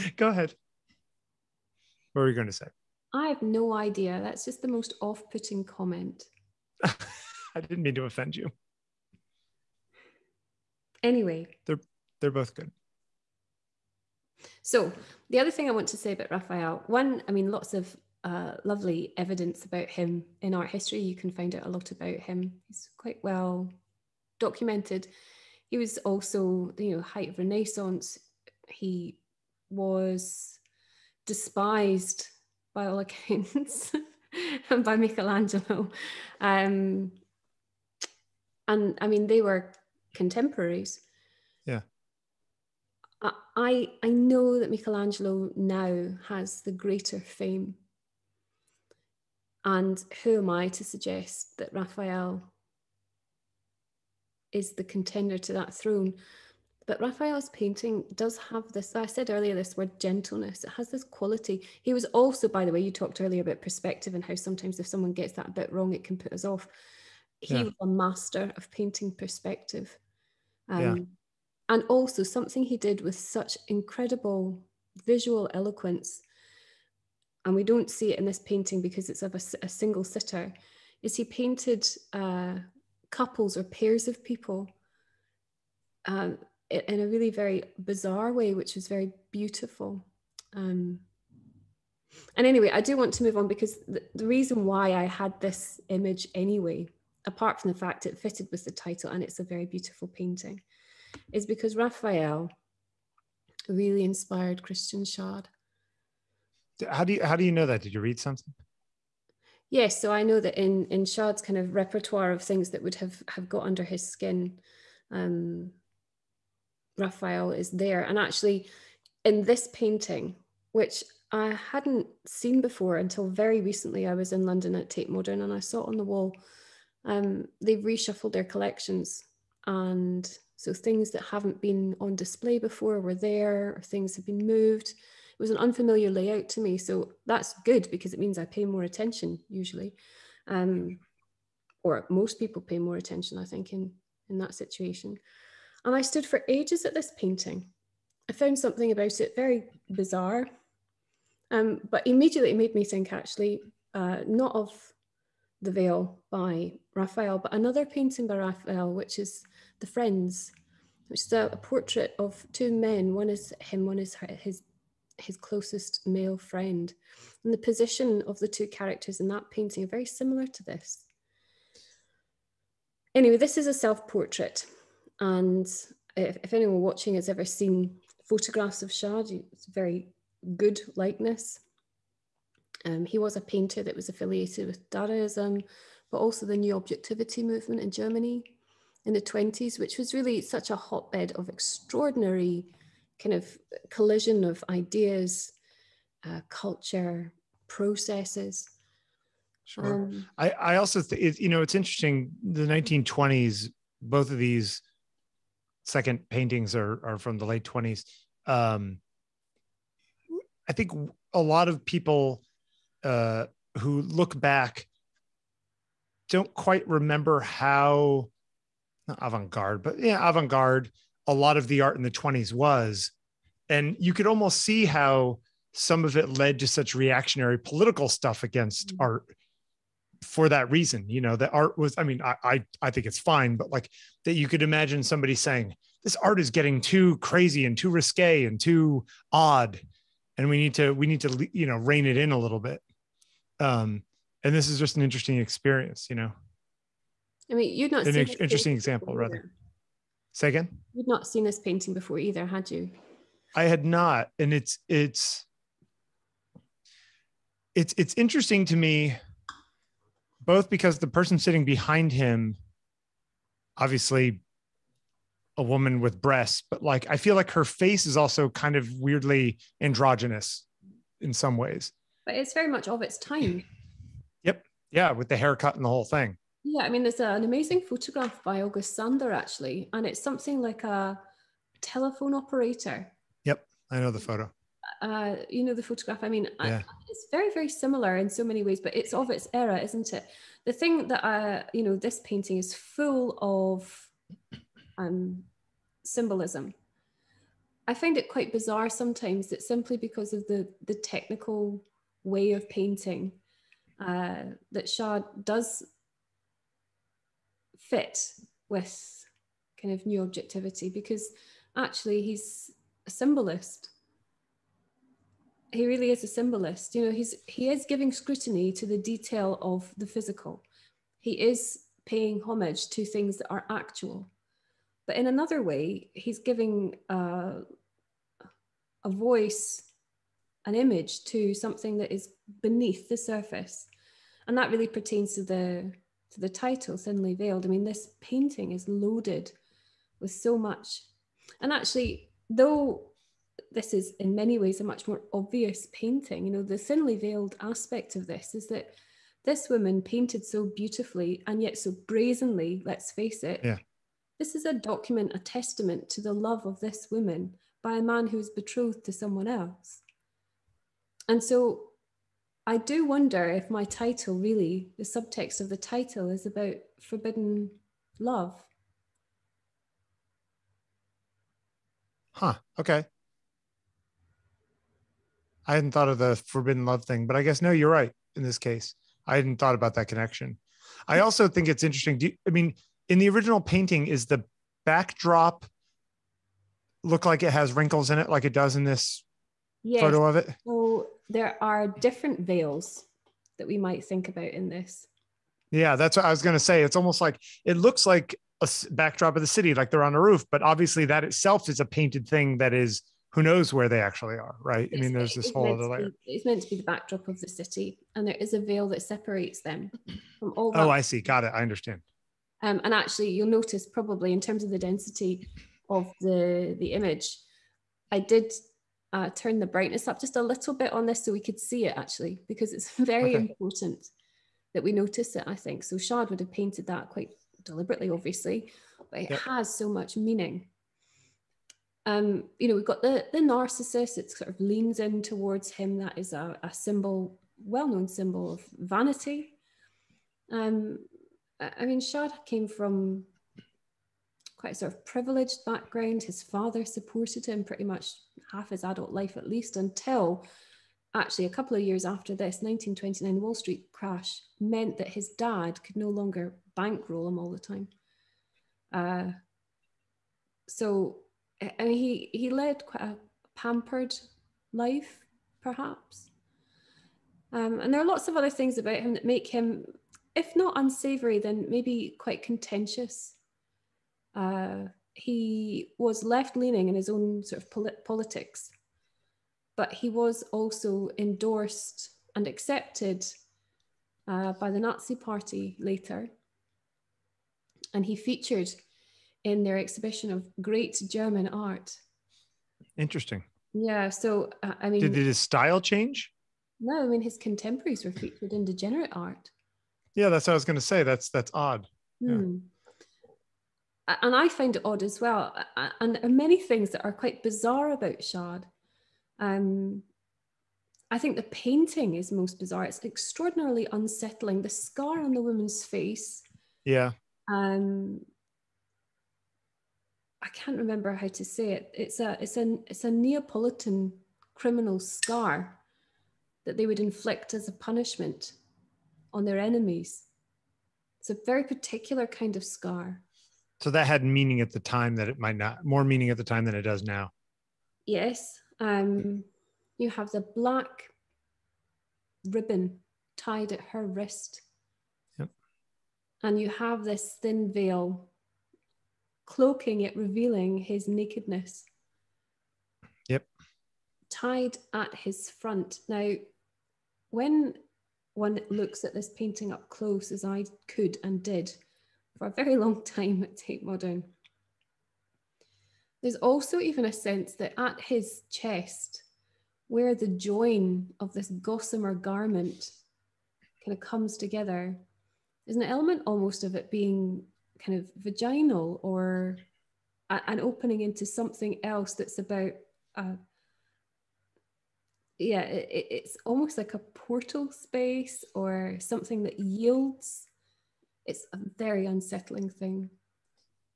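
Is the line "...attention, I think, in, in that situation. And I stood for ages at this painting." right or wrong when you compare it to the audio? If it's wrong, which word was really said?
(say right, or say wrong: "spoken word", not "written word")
right.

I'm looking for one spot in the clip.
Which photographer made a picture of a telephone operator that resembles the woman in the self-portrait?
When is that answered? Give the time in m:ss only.
4:38.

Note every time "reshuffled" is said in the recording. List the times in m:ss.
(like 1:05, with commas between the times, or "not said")
2:07.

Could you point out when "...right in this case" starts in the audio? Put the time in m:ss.
6:17.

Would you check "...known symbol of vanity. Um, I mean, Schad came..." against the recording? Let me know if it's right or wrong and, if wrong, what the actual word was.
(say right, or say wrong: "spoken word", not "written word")
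right.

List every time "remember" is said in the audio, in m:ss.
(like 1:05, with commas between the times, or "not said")
3:36, 8:40.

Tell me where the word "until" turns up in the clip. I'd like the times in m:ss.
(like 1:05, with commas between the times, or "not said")
2:02, 7:29.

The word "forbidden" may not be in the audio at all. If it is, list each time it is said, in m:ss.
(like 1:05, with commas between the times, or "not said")
6:06, 6:16.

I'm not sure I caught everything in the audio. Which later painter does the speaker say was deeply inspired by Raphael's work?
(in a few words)
Christian Schad.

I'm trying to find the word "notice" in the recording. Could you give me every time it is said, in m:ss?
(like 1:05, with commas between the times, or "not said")
6:53, 7:04.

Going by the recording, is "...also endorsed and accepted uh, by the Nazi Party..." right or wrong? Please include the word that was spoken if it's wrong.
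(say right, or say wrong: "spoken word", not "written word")
right.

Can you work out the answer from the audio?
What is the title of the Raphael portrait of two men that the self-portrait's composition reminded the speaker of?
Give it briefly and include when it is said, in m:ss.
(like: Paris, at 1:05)
The Friends, at 2:39.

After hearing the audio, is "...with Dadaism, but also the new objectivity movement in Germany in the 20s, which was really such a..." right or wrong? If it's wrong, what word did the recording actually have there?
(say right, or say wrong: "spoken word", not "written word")
right.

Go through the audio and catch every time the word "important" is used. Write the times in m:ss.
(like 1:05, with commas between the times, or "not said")
7:03.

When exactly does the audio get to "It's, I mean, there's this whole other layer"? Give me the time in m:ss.
6:44.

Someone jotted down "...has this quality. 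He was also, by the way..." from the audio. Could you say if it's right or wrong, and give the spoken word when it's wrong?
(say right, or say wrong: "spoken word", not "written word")
right.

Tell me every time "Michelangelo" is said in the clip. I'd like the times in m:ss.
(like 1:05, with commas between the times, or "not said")
0:34, 0:44.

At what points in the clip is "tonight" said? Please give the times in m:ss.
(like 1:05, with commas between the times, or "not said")
not said.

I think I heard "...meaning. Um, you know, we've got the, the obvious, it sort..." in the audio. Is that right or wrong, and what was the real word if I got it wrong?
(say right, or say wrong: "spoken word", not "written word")
wrong: "narcissus", not "obvious".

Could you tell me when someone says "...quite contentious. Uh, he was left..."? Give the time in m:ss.
7:52.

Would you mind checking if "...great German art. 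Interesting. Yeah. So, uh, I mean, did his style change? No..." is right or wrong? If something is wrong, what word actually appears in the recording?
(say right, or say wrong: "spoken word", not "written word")
right.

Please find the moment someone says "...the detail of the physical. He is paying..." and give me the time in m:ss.
5:18.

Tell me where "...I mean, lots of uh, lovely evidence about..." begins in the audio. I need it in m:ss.
0:17.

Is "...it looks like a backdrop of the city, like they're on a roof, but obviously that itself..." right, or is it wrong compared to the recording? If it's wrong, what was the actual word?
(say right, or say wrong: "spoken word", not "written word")
right.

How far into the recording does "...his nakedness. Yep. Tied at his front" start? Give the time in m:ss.
9:10.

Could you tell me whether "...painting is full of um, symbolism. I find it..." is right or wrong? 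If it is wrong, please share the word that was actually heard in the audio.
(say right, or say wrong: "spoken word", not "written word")
right.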